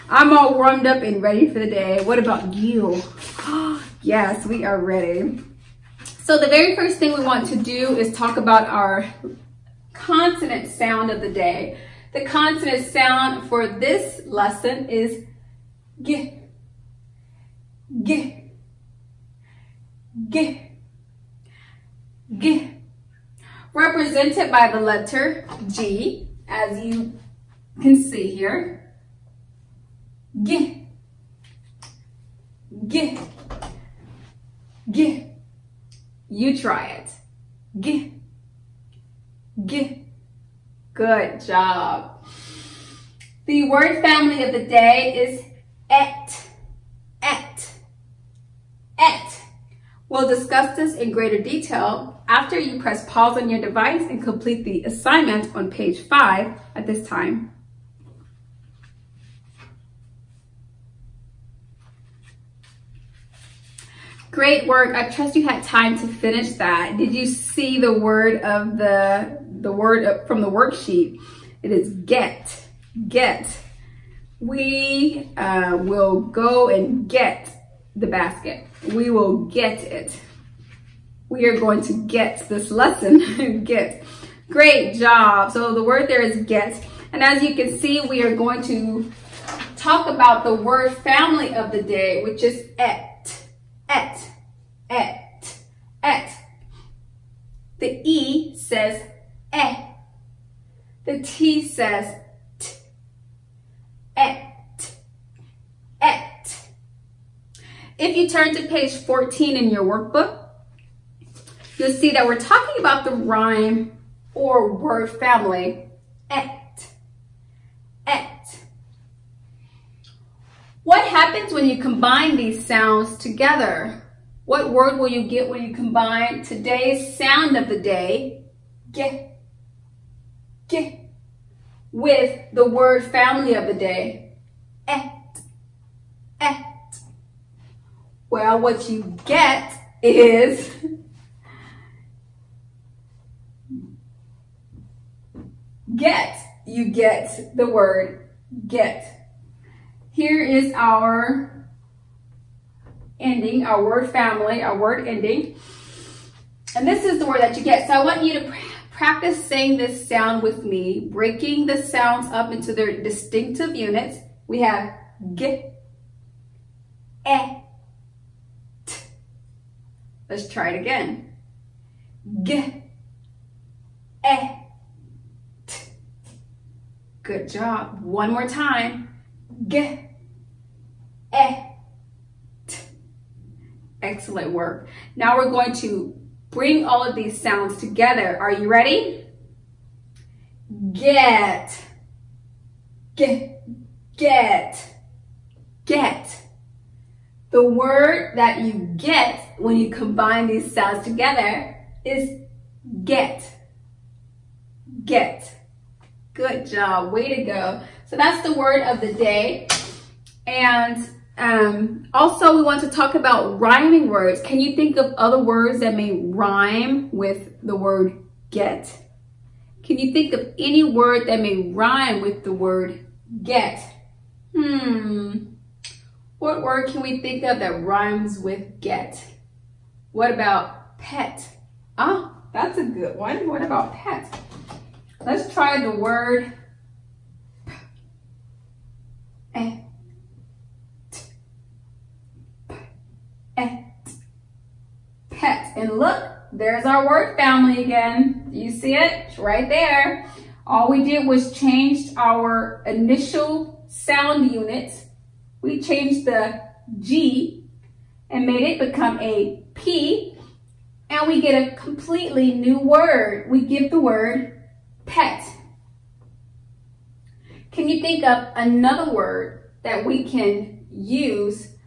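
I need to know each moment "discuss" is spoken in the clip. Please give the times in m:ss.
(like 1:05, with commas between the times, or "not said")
0:50.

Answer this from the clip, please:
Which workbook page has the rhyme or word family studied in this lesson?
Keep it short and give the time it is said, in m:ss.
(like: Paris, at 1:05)
14, at 1:48.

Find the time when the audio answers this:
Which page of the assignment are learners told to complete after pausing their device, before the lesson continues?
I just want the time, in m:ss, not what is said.
0:55.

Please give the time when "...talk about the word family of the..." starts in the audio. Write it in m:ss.
1:29.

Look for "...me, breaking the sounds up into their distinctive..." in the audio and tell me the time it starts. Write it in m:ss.
2:40.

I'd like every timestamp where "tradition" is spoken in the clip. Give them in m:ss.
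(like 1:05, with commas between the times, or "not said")
not said.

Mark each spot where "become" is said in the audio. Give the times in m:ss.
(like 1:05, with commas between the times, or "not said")
4:18.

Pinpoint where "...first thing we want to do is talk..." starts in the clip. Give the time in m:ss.
0:06.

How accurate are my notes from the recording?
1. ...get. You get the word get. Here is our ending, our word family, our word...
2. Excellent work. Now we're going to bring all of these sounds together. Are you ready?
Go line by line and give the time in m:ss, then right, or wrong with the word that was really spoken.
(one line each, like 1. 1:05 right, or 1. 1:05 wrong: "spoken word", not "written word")
1. 2:25 right
2. 3:04 right.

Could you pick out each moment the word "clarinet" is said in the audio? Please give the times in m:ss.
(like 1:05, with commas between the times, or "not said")
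not said.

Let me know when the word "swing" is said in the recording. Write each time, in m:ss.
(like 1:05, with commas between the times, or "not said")
not said.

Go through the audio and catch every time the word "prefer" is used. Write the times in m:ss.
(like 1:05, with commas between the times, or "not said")
not said.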